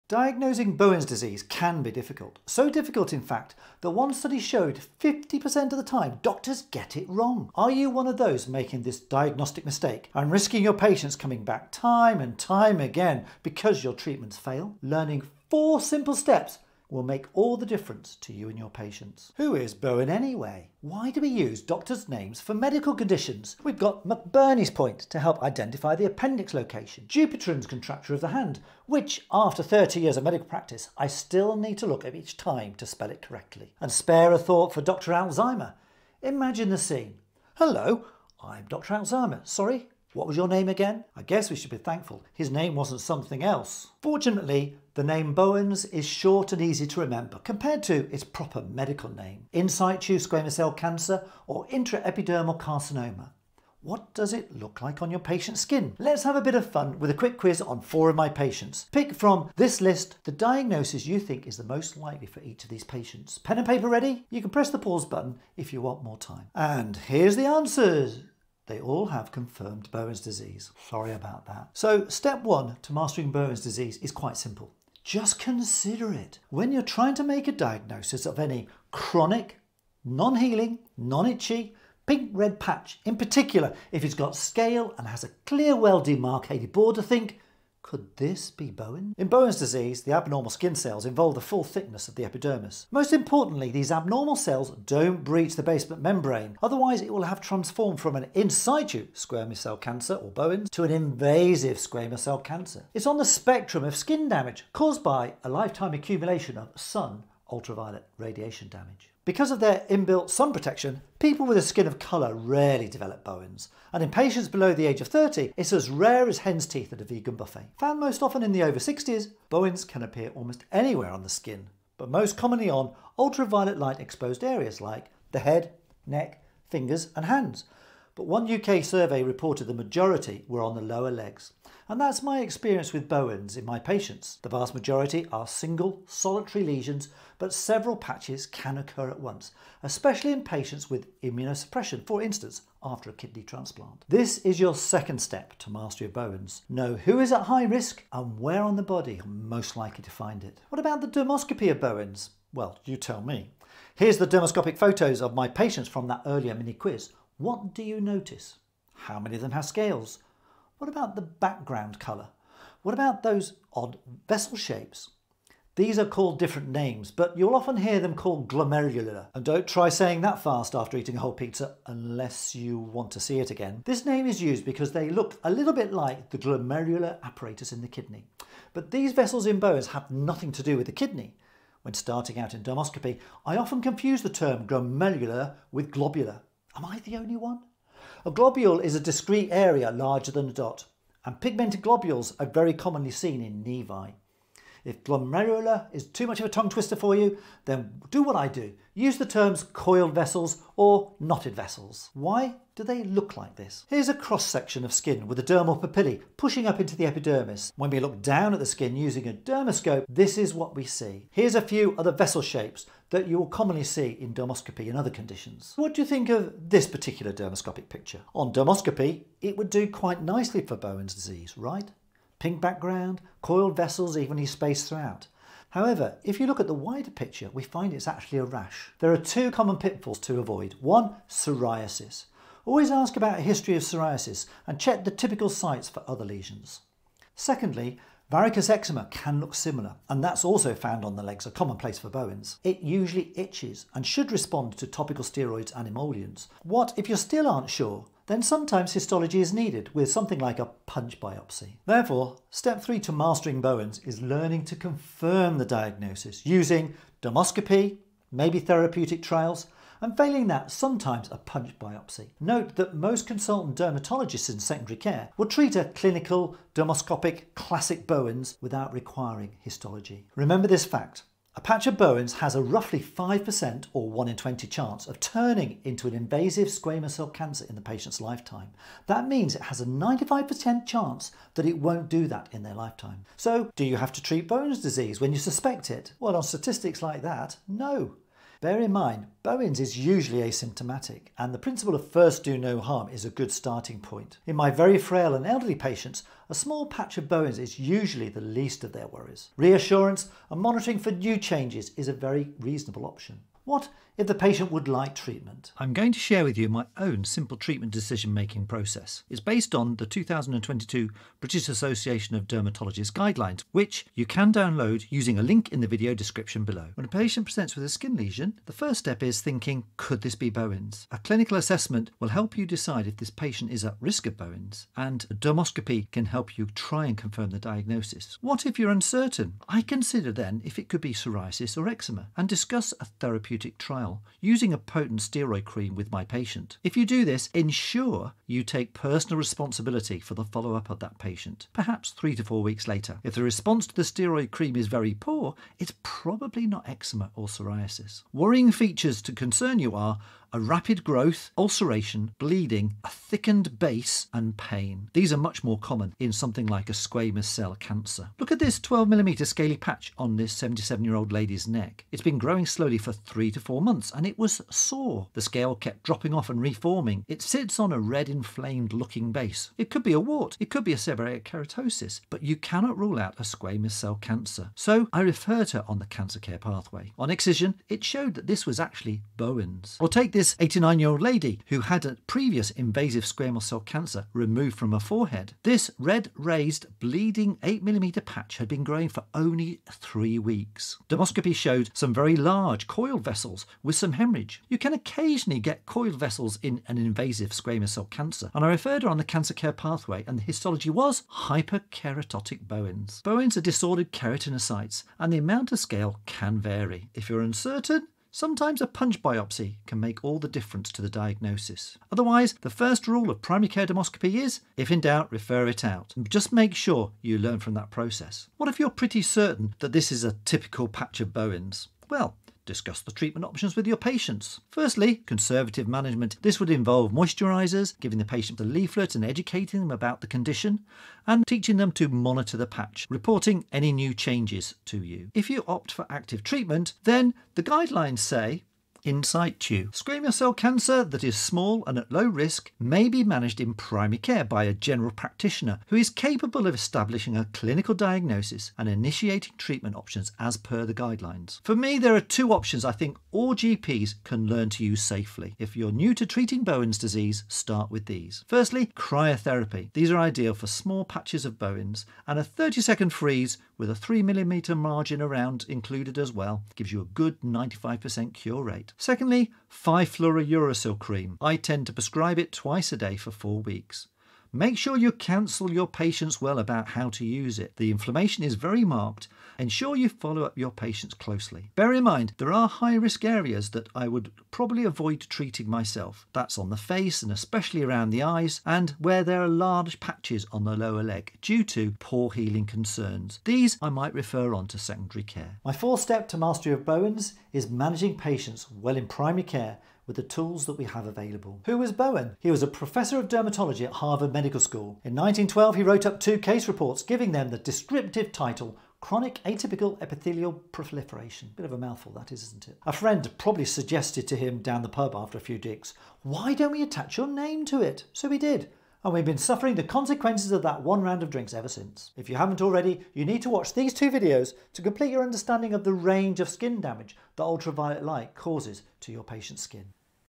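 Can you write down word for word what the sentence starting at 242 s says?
It usually itches and should respond to topical steroids and emollients.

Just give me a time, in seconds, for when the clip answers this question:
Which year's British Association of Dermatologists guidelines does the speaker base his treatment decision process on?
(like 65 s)
310 s.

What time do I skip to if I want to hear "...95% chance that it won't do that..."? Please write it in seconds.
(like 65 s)
279 s.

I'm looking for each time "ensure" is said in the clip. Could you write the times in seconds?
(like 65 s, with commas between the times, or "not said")
337 s, 479 s.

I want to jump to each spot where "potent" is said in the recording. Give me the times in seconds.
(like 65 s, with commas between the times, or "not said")
334 s.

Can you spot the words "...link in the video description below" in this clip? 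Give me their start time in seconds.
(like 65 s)
315 s.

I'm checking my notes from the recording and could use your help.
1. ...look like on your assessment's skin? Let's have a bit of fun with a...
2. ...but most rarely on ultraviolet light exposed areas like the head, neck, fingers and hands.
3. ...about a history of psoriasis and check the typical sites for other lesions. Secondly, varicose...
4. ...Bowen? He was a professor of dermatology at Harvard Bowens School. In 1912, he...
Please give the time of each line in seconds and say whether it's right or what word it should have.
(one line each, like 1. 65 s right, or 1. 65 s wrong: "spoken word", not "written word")
1. 54 s wrong: "patient", not "assessment"
2. 121 s wrong: "commonly", not "rarely"
3. 233 s right
4. 501 s wrong: "Medical", not "Bowens".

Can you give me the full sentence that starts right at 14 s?
Learning four simple steps will make all the difference to you and your patients.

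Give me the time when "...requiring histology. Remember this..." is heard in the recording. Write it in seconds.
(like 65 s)
268 s.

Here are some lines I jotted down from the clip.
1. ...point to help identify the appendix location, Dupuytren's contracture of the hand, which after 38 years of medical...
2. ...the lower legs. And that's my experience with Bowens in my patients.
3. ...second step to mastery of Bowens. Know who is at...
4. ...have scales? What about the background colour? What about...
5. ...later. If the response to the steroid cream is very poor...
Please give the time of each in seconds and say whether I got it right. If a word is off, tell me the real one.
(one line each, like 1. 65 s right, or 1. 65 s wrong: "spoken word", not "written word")
1. 24 s wrong: "30", not "38"
2. 130 s right
3. 144 s right
4. 159 s right
5. 342 s right.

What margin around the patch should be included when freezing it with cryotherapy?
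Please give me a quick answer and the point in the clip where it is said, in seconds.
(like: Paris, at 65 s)
3mm, at 463 s.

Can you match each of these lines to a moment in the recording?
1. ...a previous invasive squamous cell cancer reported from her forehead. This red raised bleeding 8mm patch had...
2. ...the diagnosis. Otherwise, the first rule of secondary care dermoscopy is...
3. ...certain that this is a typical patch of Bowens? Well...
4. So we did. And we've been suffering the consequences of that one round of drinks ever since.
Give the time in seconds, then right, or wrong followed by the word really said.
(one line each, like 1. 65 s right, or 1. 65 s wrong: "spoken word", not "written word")
1. 382 s wrong: "removed", not "reported"
2. 411 s wrong: "primary", not "secondary"
3. 419 s right
4. 518 s right.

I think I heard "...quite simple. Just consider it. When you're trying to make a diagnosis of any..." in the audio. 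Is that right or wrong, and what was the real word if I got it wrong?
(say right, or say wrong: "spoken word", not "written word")
right.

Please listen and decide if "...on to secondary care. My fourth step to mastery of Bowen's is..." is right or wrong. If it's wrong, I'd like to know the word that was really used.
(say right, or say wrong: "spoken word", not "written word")
right.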